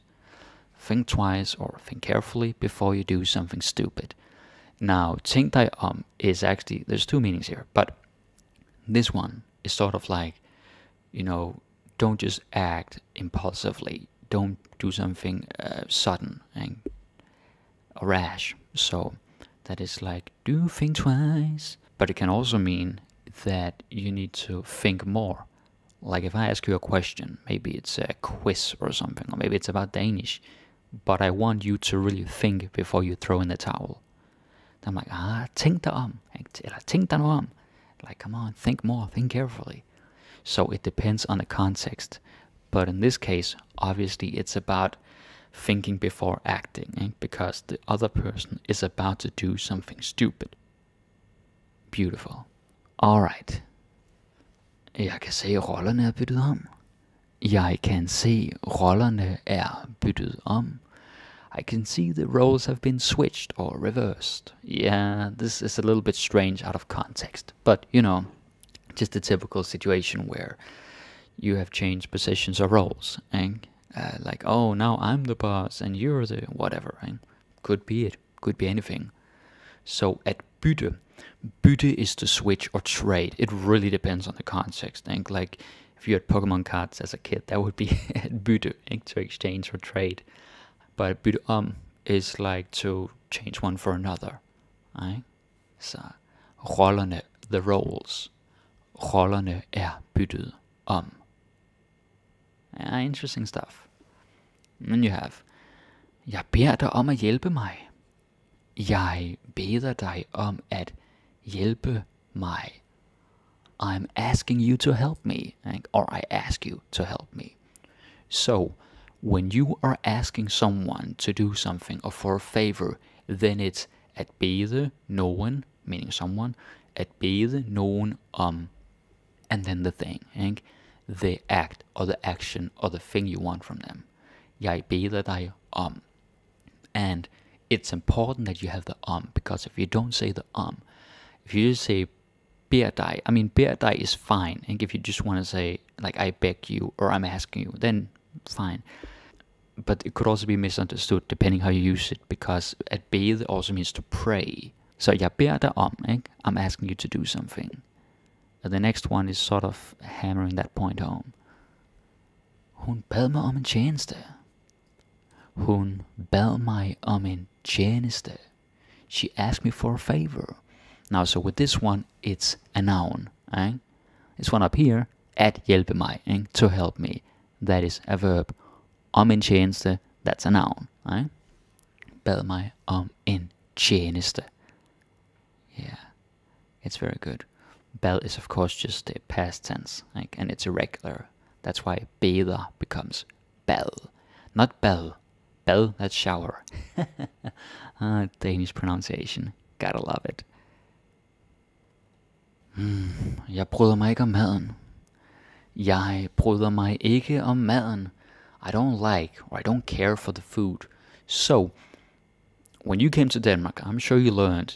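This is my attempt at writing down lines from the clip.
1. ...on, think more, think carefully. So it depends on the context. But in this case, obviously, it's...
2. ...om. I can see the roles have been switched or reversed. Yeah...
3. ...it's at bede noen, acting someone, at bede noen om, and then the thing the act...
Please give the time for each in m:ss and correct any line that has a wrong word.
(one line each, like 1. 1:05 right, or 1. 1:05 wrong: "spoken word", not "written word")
1. 0:38 right
2. 1:00 right
3. 2:03 wrong: "meaning", not "acting".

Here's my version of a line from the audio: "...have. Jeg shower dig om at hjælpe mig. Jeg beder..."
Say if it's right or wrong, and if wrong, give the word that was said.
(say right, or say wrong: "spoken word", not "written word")
wrong: "beder", not "shower".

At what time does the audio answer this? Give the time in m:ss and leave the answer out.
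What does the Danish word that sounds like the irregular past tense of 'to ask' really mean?
3:16.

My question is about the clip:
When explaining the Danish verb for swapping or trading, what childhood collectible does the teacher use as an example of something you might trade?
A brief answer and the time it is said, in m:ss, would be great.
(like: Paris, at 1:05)
Pokémon cards, at 1:26.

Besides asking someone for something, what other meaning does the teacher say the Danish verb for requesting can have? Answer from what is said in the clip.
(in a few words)
to pray.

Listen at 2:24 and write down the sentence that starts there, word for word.
And if you just want to say like I beg you or I'm asking you, then fine.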